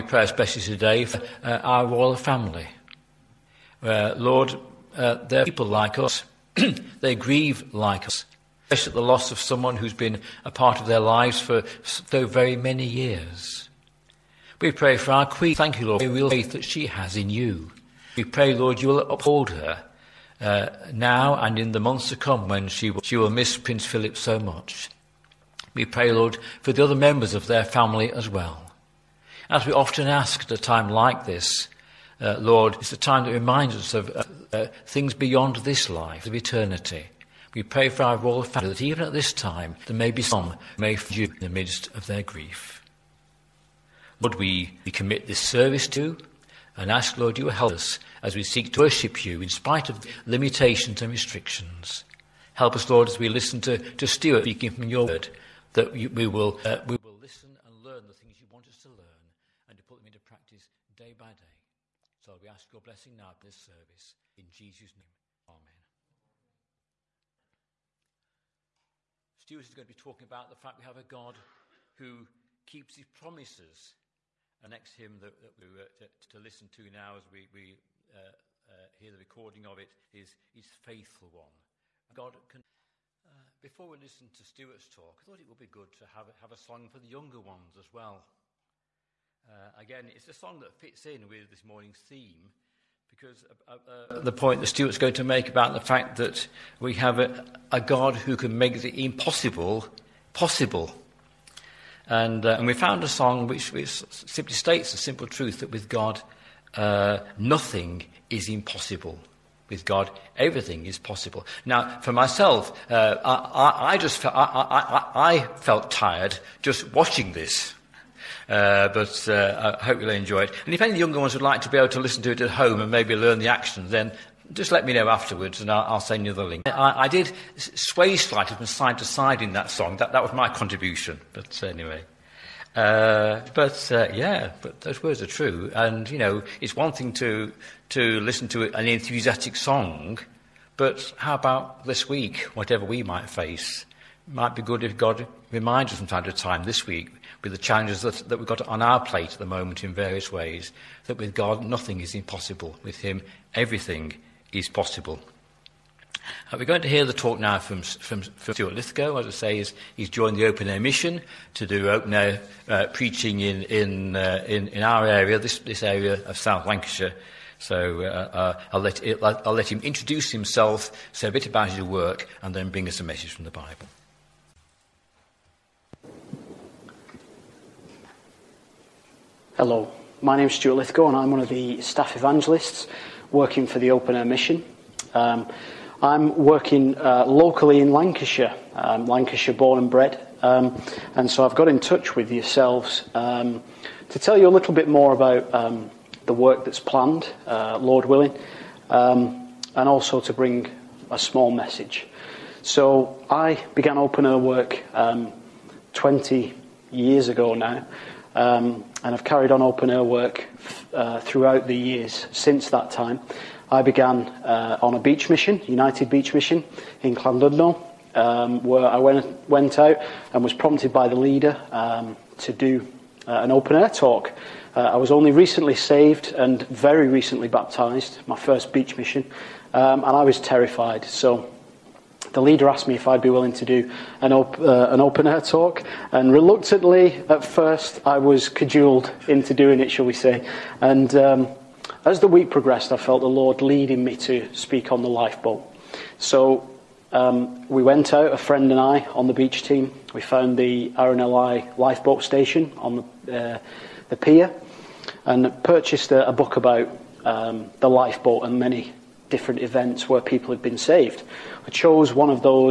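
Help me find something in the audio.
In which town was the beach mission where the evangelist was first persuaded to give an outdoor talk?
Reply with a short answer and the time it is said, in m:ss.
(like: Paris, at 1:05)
Llandudno, at 3:37.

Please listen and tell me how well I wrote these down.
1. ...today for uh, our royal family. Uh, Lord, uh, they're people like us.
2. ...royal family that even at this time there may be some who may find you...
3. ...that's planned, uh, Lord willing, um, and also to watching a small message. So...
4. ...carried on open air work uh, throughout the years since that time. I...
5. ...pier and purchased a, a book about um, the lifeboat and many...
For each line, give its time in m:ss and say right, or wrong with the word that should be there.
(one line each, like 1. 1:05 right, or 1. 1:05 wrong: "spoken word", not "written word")
1. 0:00 right
2. 0:38 right
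3. 3:16 wrong: "bring", not "watching"
4. 3:29 right
5. 4:14 right.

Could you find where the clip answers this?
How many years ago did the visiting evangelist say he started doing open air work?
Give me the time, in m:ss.
3:25.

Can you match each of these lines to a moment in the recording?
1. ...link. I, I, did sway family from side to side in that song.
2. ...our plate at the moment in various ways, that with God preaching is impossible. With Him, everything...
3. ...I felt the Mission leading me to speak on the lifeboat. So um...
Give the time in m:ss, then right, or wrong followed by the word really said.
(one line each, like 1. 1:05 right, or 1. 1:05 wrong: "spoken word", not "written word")
1. 2:06 wrong: "slightly", not "family"
2. 2:28 wrong: "nothing", not "preaching"
3. 4:02 wrong: "Lord", not "Mission".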